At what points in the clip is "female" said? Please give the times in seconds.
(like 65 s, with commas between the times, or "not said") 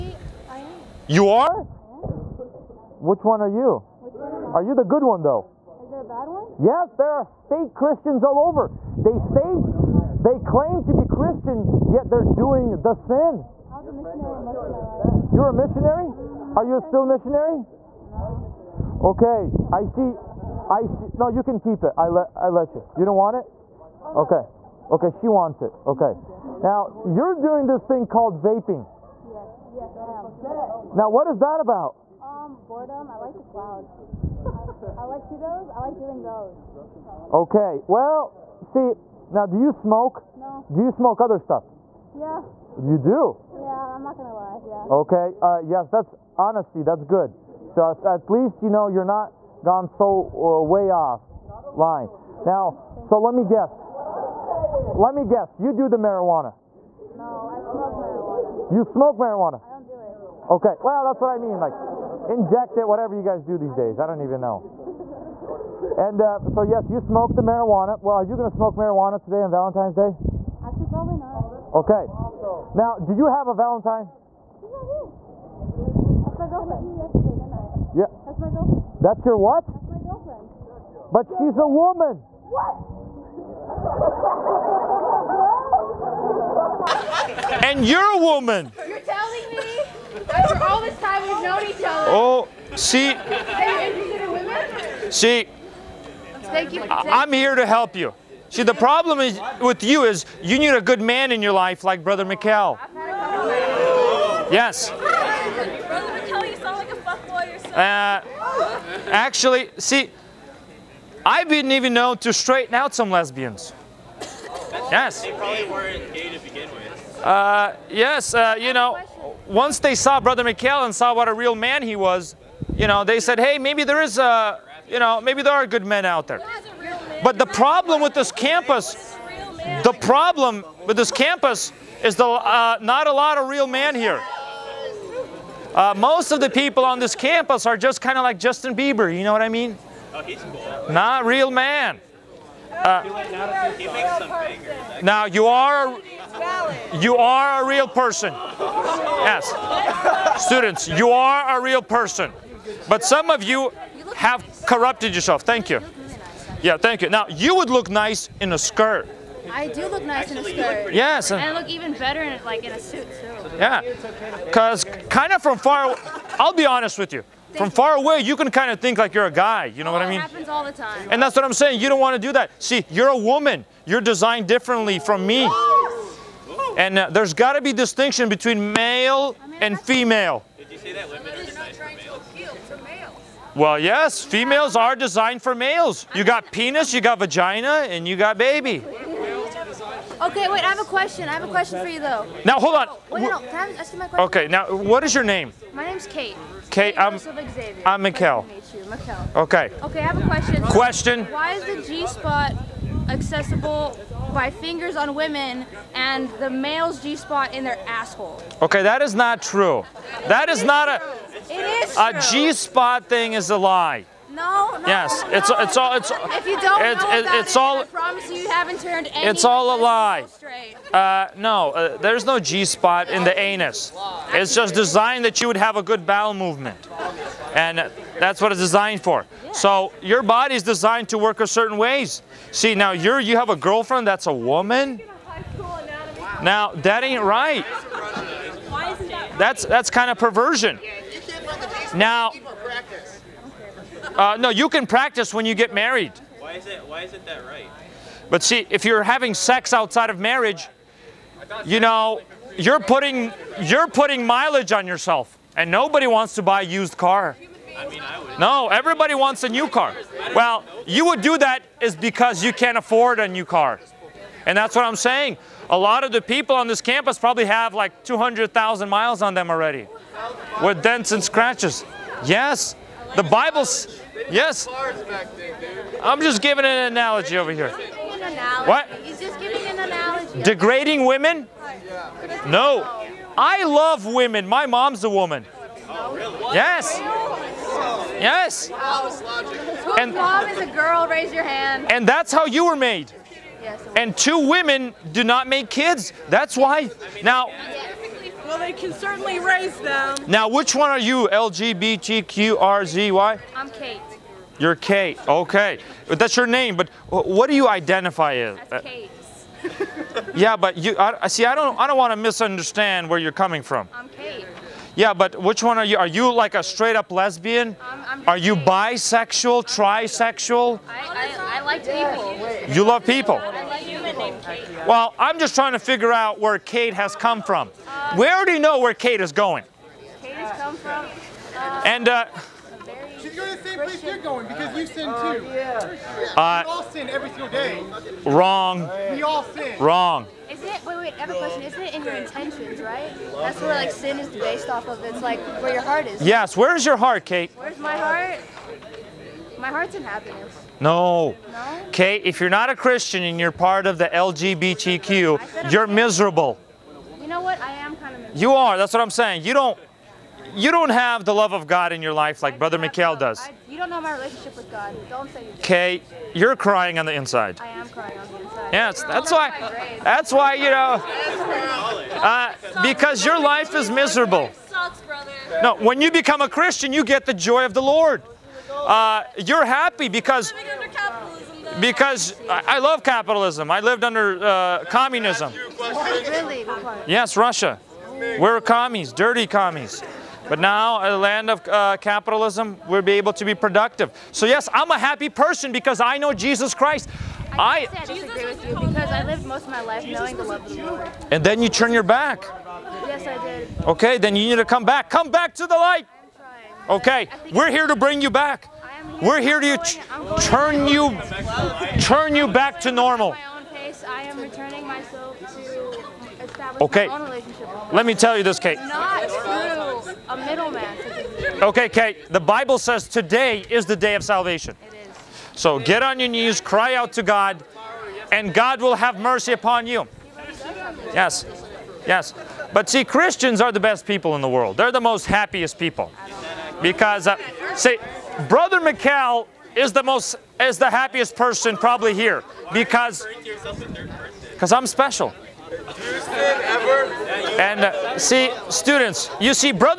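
179 s, 184 s.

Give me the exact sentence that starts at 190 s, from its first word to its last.
Okay, wait, I have a question.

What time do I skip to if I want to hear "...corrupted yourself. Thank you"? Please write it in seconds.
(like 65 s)
154 s.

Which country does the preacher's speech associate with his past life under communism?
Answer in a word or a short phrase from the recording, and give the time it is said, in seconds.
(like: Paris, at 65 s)
Russia, at 387 s.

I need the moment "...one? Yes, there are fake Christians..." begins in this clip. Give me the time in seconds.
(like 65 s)
6 s.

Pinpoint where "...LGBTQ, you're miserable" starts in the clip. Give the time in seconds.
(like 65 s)
354 s.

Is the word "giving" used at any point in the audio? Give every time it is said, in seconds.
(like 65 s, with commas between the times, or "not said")
276 s.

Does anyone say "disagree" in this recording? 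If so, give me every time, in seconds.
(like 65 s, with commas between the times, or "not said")
398 s.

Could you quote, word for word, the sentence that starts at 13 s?
I was a missionary most of my life.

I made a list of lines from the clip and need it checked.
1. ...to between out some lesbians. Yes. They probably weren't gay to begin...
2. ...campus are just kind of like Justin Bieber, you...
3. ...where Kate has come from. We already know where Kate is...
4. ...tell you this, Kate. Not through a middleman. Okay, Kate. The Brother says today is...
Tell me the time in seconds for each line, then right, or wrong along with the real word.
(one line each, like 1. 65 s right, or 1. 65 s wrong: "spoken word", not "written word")
1. 112 s wrong: "straighten", not "between"
2. 137 s right
3. 326 s right
4. 418 s wrong: "Bible", not "Brother".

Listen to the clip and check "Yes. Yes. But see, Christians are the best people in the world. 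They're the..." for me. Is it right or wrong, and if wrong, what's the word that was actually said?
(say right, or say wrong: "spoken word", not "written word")
right.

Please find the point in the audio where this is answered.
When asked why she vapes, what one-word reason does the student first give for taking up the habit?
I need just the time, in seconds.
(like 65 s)
32 s.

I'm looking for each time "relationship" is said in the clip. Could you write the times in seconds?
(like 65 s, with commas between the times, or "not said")
364 s, 417 s.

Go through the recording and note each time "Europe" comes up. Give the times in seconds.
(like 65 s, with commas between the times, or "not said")
not said.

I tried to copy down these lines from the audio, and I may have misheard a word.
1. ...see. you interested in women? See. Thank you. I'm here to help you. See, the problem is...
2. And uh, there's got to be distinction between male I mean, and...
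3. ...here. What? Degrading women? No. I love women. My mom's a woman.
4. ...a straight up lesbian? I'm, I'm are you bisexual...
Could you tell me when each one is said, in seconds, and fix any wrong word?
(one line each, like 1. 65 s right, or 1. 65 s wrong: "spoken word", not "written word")
1. 92 s right
2. 176 s right
3. 277 s right
4. 316 s right.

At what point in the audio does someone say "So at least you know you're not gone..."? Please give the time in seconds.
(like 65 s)
47 s.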